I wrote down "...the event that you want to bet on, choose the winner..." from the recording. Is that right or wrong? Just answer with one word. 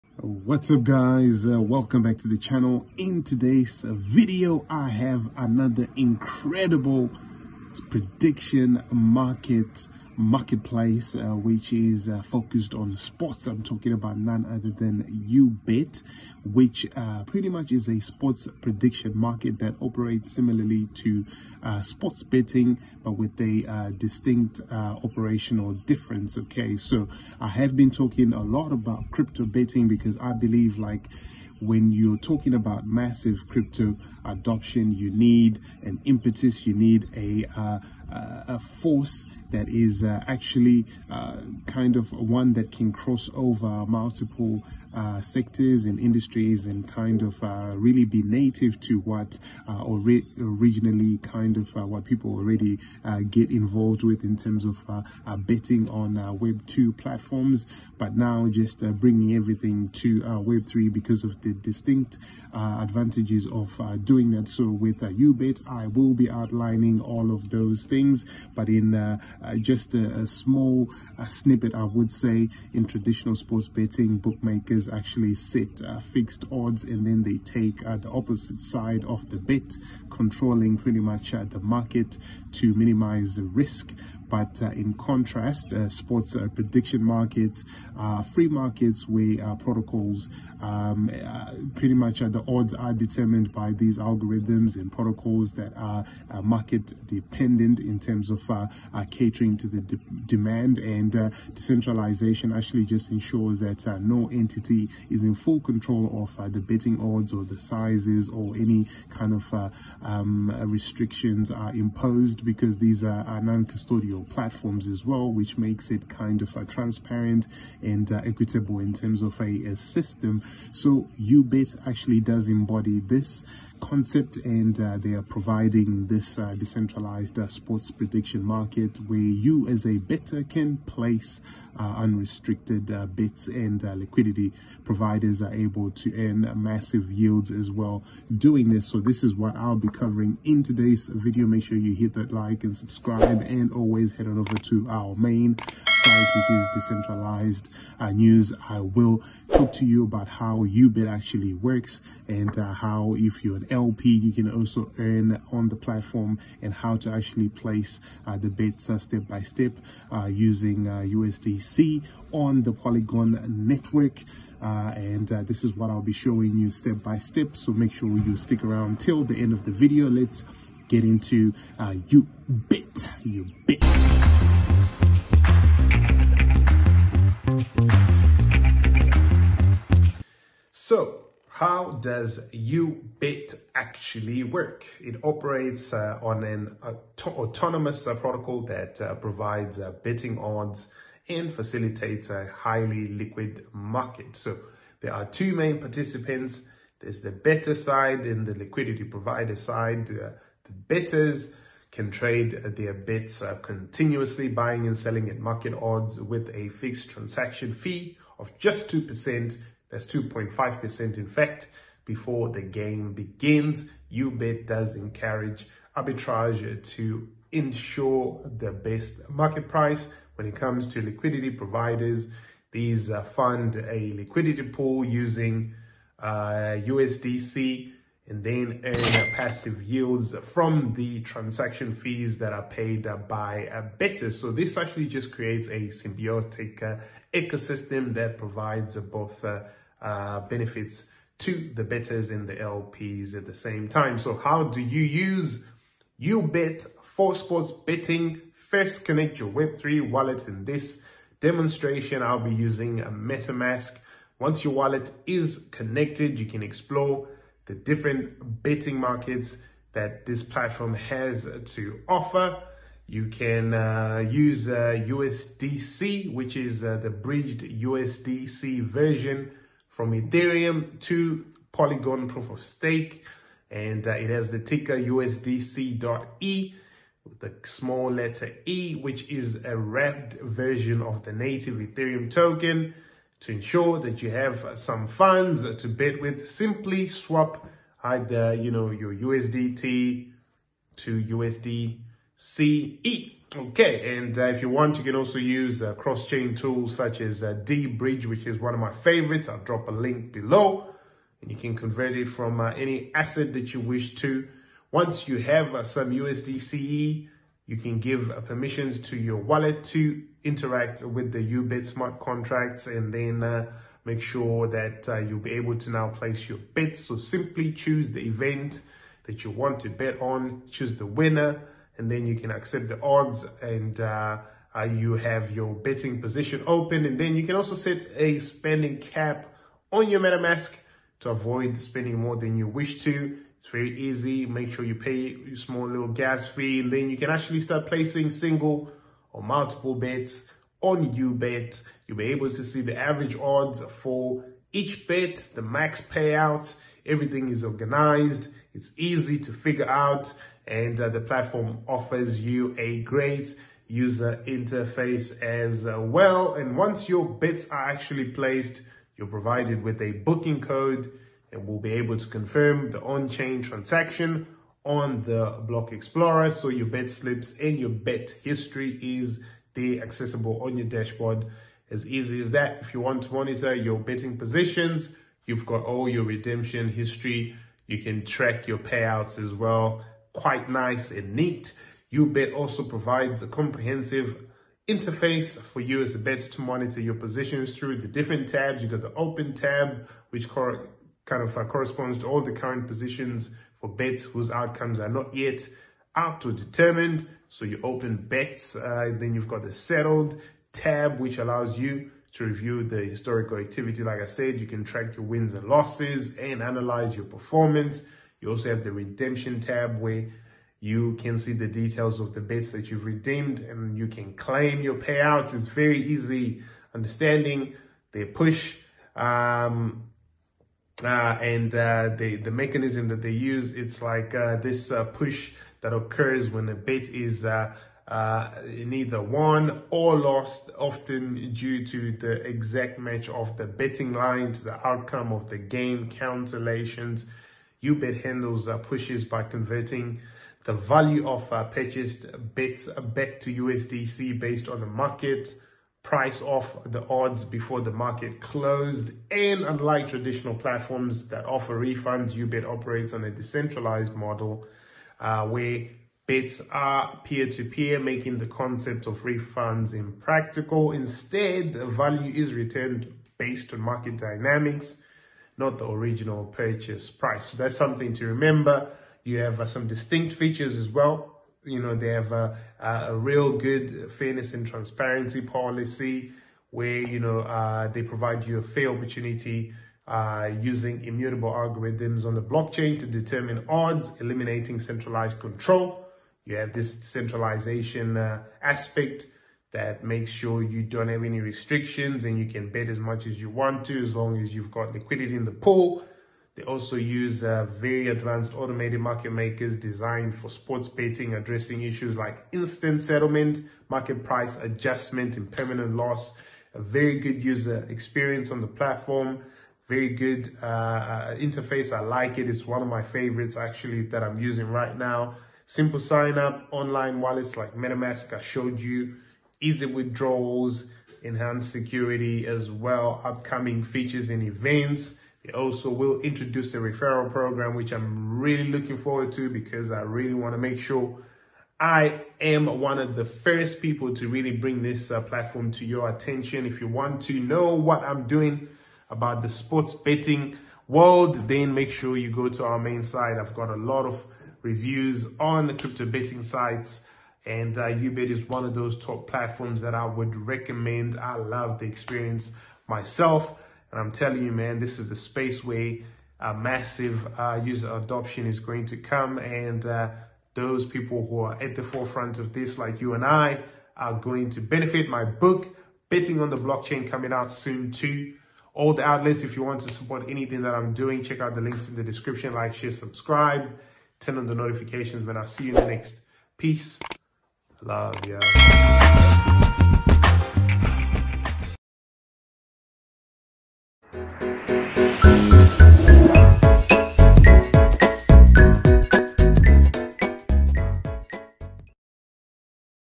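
right.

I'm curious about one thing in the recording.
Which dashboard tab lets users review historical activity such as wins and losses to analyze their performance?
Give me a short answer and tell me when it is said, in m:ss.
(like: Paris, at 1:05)
Settled tab, at 6:39.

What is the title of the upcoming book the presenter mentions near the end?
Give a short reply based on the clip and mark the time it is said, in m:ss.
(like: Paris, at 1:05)
Betting on the Blockchain, at 9:26.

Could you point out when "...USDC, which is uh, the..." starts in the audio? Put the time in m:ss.
4:25.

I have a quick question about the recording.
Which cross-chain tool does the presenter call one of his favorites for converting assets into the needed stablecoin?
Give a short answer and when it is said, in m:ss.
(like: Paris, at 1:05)
deBridge, at 4:57.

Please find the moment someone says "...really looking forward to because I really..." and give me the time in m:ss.
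8:48.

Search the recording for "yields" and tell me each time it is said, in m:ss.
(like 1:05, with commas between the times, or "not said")
2:17, 3:49.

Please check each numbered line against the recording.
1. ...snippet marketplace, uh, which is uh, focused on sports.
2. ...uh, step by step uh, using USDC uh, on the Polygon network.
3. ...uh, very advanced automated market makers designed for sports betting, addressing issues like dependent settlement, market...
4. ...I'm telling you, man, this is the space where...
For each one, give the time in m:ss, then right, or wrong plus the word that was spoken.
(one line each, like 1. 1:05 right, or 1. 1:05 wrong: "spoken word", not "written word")
1. 0:08 wrong: "market", not "snippet"
2. 2:38 right
3. 8:17 wrong: "instant", not "dependent"
4. 9:13 right.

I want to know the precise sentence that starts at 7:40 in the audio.
Instead, value is returned based on market dynamics not the original purchase price.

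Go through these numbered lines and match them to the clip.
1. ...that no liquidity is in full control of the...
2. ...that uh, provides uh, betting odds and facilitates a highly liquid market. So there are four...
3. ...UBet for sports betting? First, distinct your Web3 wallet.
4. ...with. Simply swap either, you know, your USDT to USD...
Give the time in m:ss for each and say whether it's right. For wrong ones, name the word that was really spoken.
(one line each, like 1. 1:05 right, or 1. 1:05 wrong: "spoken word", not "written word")
1. 1:43 wrong: "entity", not "liquidity"
2. 3:08 wrong: "two", not "four"
3. 4:06 wrong: "connect", not "distinct"
4. 4:46 right.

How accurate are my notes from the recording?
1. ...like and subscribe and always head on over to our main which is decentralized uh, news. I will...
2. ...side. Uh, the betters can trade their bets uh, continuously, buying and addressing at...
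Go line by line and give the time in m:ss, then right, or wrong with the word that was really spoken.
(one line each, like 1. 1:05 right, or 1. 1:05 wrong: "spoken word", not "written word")
1. 2:22 right
2. 3:19 wrong: "selling", not "addressing".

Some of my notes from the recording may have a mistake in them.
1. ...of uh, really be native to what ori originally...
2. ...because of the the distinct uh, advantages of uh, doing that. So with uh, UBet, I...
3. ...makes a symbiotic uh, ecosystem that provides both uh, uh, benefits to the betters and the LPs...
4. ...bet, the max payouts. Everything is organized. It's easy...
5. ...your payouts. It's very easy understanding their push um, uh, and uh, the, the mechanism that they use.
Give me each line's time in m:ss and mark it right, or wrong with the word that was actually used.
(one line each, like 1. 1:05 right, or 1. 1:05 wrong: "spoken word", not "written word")
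1. 0:47 right
2. 1:00 right
3. 3:55 wrong: "creates", not "makes"
4. 5:45 right
5. 6:54 right.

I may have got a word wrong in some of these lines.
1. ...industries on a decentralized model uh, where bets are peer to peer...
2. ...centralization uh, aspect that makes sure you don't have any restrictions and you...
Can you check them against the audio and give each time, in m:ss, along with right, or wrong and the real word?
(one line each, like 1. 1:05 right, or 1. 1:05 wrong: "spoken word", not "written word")
1. 7:32 wrong: "operates", not "industries"
2. 8:07 right.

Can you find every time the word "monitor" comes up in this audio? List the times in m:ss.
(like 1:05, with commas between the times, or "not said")
6:13, 6:26.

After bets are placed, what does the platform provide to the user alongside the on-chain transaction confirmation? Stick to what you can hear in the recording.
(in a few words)
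A booking code.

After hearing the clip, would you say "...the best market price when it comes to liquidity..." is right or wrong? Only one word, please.
right.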